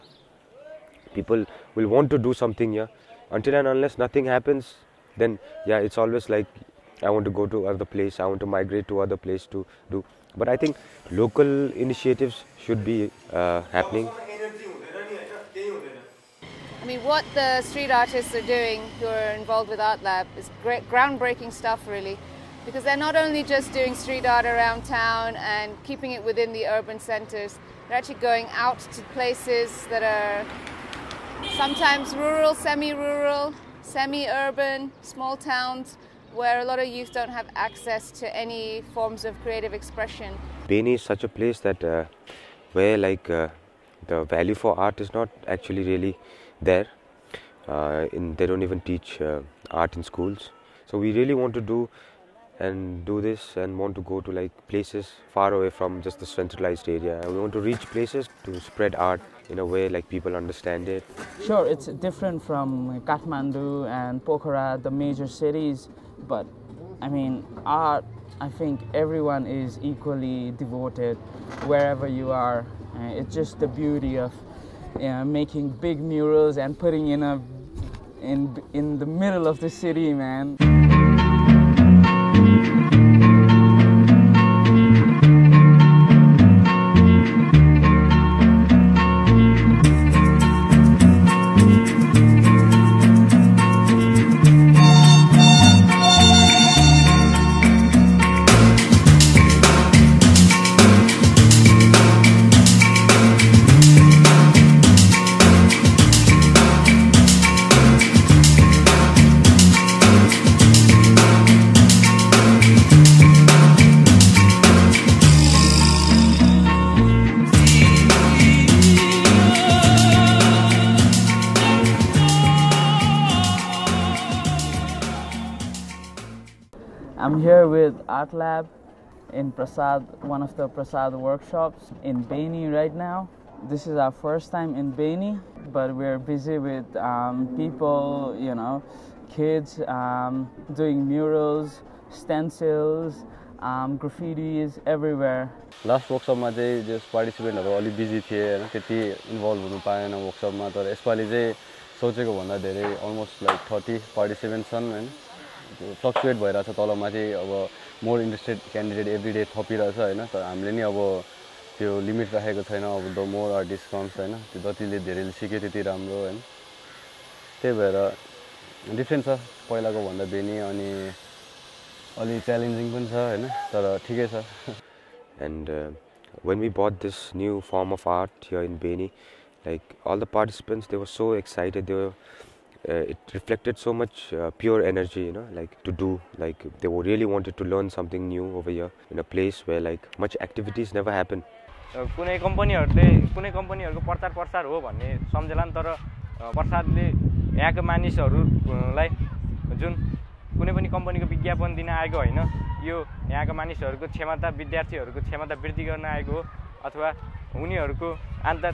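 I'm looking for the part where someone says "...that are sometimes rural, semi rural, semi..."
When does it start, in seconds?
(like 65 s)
29 s.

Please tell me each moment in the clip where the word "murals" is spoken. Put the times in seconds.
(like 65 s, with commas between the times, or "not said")
75 s, 141 s.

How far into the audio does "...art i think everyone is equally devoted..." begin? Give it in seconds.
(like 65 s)
67 s.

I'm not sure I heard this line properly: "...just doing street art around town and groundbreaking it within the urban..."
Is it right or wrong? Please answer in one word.
wrong.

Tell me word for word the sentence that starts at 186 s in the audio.
Like they really wanted to learn something new over here in a place where like much activities never happen.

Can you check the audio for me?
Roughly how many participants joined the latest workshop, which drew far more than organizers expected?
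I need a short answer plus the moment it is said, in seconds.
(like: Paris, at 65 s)
30, at 153 s.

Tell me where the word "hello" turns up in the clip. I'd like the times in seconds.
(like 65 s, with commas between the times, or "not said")
not said.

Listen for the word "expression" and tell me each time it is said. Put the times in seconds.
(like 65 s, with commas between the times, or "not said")
39 s.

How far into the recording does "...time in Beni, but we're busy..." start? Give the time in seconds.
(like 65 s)
134 s.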